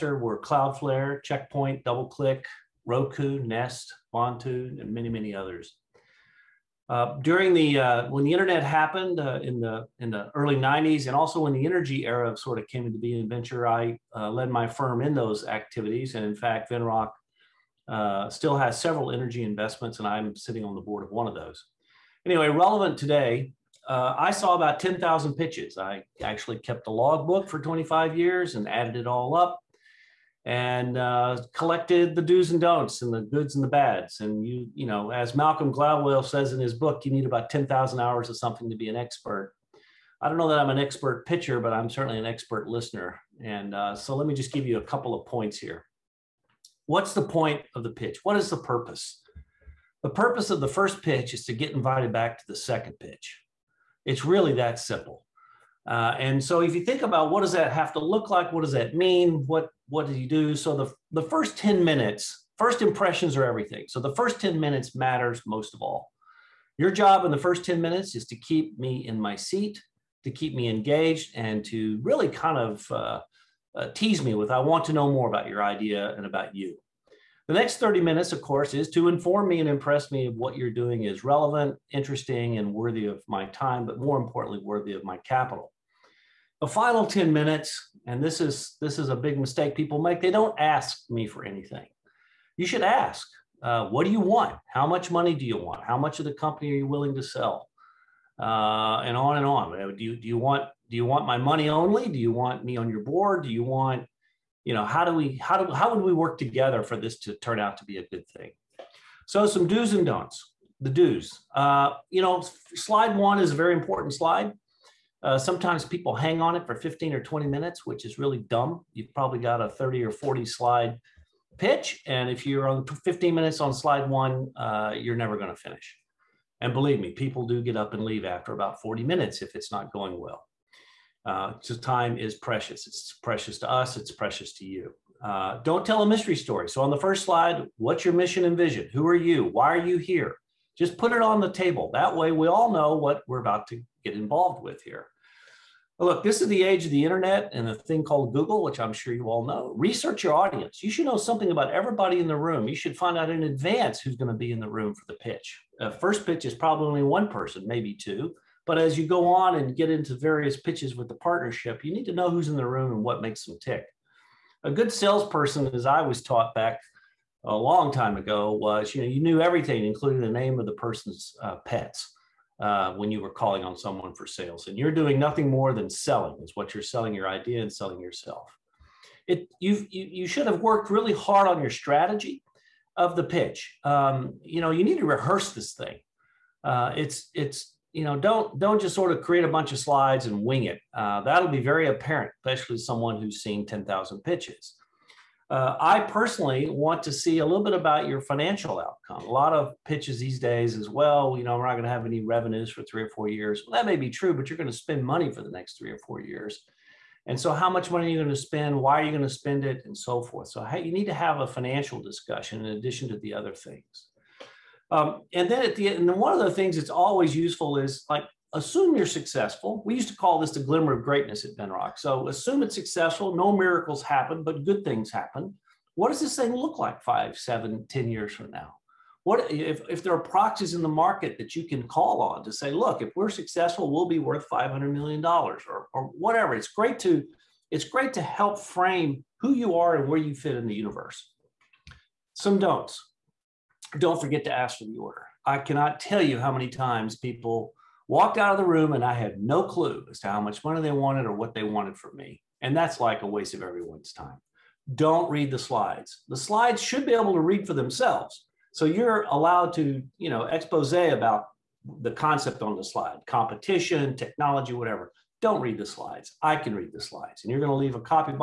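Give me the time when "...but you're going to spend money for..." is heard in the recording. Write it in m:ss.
3:24.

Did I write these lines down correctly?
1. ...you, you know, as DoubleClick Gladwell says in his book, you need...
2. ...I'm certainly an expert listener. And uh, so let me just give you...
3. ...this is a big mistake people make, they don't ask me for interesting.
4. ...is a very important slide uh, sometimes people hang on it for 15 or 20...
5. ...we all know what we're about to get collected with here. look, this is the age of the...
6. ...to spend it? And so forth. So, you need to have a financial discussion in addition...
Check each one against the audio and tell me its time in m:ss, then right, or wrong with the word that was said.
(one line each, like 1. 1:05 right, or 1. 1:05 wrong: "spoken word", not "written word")
1. 0:34 wrong: "Malcolm", not "DoubleClick"
2. 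0:41 right
3. 1:28 wrong: "anything", not "interesting"
4. 1:53 right
5. 2:22 wrong: "involved", not "collected"
6. 3:29 right.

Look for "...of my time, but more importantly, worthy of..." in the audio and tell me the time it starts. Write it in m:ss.
1:23.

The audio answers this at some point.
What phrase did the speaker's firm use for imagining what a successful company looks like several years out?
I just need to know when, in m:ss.
3:40.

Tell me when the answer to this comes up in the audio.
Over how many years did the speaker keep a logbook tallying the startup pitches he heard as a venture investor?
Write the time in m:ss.
0:27.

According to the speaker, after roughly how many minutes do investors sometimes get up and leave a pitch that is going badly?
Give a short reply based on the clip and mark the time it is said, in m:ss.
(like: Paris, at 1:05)
40 minutes, at 2:08.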